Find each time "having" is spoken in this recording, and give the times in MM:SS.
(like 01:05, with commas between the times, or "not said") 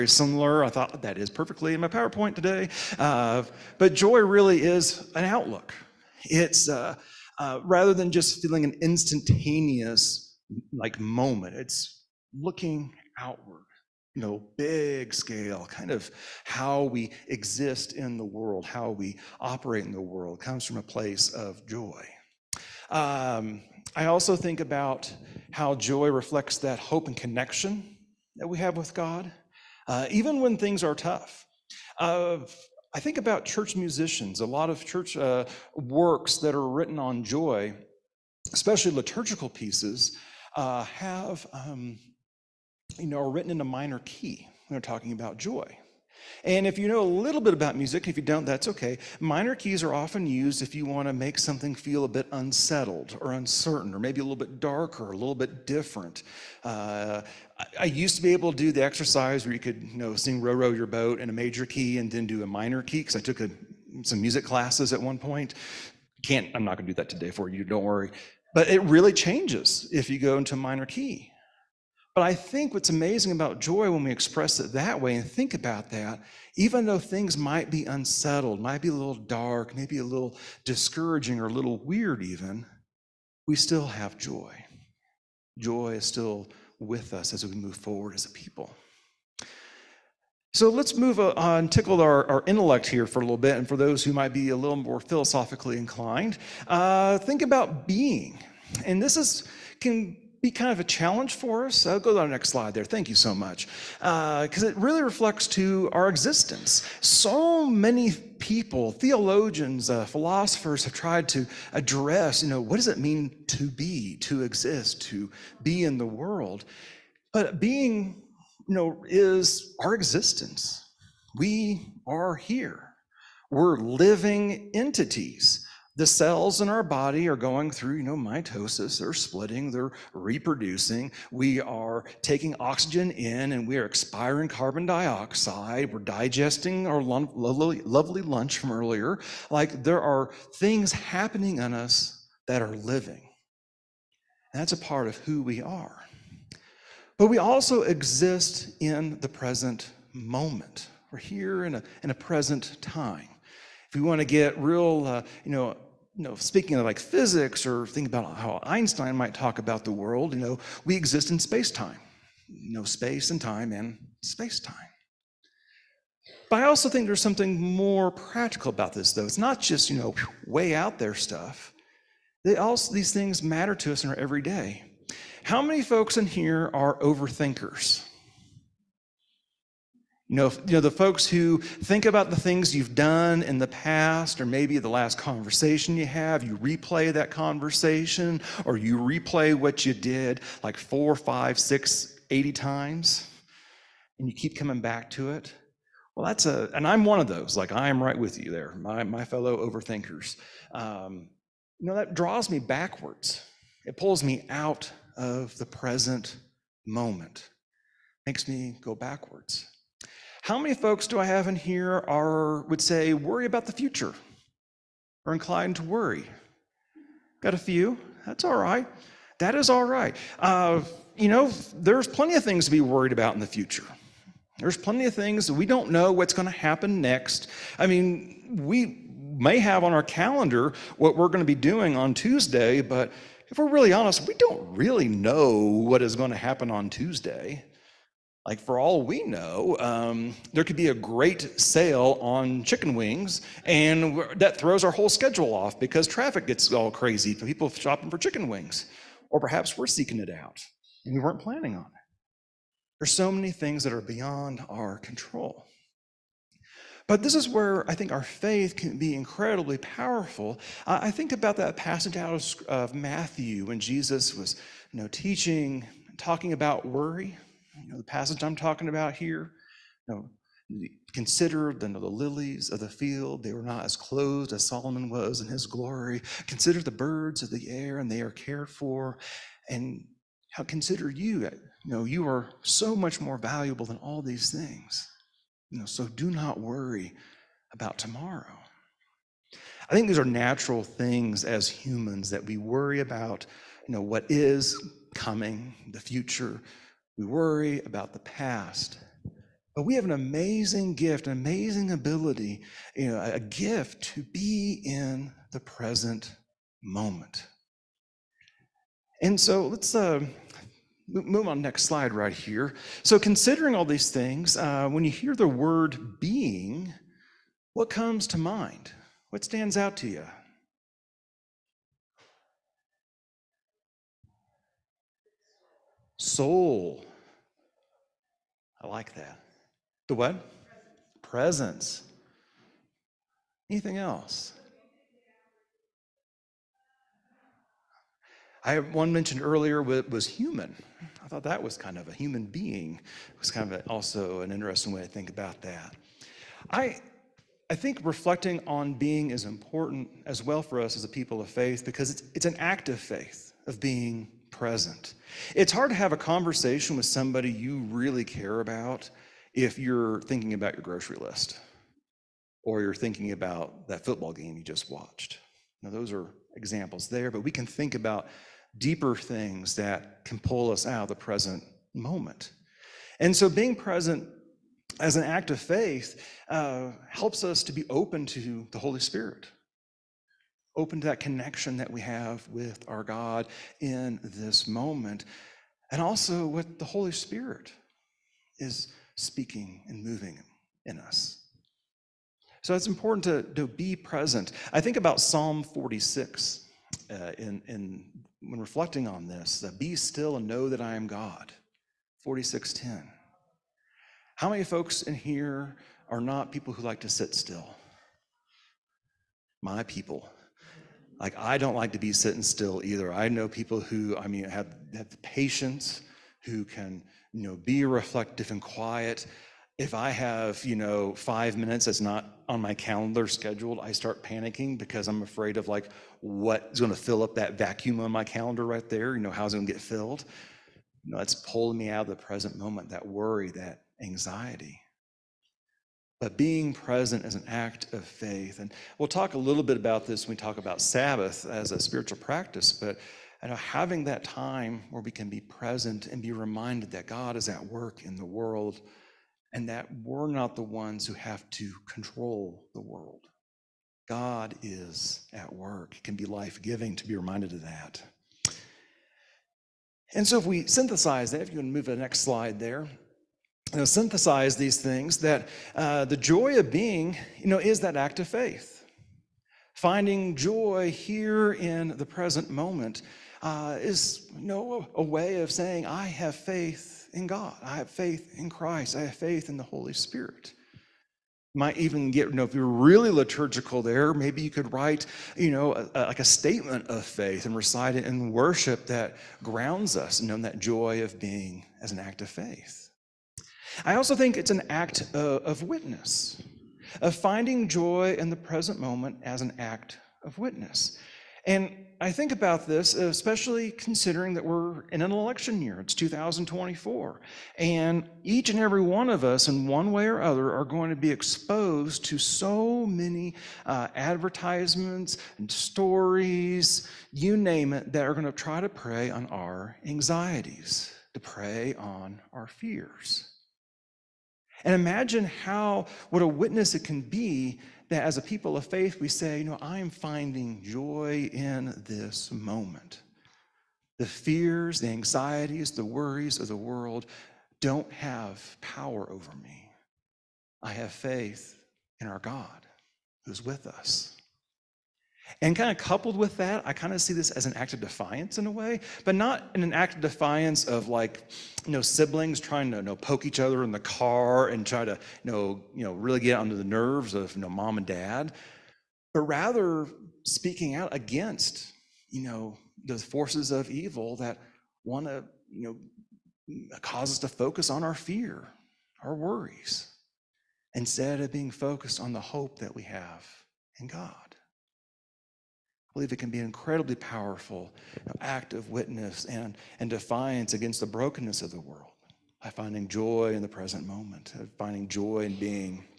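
07:23.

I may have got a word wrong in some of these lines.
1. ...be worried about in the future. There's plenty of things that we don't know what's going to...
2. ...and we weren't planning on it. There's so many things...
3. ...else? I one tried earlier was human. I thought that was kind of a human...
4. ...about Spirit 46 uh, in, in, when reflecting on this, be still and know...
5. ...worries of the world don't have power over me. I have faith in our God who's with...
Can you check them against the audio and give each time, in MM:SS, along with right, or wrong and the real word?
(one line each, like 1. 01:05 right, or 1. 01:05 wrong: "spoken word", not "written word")
1. 03:42 right
2. 04:11 right
3. 05:33 wrong: "mentioned", not "tried"
4. 06:34 wrong: "Psalm", not "Spirit"
5. 08:55 right.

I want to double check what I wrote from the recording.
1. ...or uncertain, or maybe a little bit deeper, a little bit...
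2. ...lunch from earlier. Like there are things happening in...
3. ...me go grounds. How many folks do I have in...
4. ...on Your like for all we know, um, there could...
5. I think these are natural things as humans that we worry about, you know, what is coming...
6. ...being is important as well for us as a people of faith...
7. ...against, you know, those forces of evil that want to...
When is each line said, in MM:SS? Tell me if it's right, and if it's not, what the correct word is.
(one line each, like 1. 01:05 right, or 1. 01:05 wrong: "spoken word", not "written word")
1. 00:53 wrong: "darker", not "deeper"
2. 02:18 right
3. 03:28 wrong: "backwards", not "grounds"
4. 03:56 wrong: "Tuesday", not "Your"
5. 04:49 right
6. 05:48 right
7. 09:20 right.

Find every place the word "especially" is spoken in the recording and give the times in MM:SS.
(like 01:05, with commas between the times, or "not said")
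00:38, 08:22.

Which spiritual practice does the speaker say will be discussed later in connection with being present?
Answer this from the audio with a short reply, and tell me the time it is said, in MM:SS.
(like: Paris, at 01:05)
Sabbath, at 07:20.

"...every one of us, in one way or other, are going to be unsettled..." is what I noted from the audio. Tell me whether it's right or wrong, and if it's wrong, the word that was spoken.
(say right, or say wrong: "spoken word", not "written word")
wrong: "exposed", not "unsettled".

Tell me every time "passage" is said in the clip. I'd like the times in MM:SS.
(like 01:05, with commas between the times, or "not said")
04:21, 04:28.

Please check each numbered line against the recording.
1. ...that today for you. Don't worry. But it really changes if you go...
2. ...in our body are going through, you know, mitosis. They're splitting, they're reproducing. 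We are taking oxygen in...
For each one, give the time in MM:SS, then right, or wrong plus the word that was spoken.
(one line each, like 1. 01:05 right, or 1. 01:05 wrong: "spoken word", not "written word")
1. 01:06 right
2. 02:06 right.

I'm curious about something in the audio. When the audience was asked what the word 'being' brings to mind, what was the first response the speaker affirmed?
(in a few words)
Soul.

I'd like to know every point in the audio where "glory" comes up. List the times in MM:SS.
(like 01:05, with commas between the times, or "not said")
04:35.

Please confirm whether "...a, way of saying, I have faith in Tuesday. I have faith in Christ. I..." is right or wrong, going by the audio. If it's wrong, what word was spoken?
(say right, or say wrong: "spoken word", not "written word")
wrong: "God", not "Tuesday".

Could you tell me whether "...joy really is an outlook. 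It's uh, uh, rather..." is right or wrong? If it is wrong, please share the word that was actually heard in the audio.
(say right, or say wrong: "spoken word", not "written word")
right.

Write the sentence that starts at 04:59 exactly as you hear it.
But we have an amazing gift, an amazing ability, you know, a gift to be in the present moment.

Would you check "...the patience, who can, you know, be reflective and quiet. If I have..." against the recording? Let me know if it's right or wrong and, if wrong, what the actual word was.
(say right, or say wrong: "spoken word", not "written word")
right.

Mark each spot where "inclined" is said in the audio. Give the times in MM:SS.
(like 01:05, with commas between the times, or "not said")
01:35, 03:35.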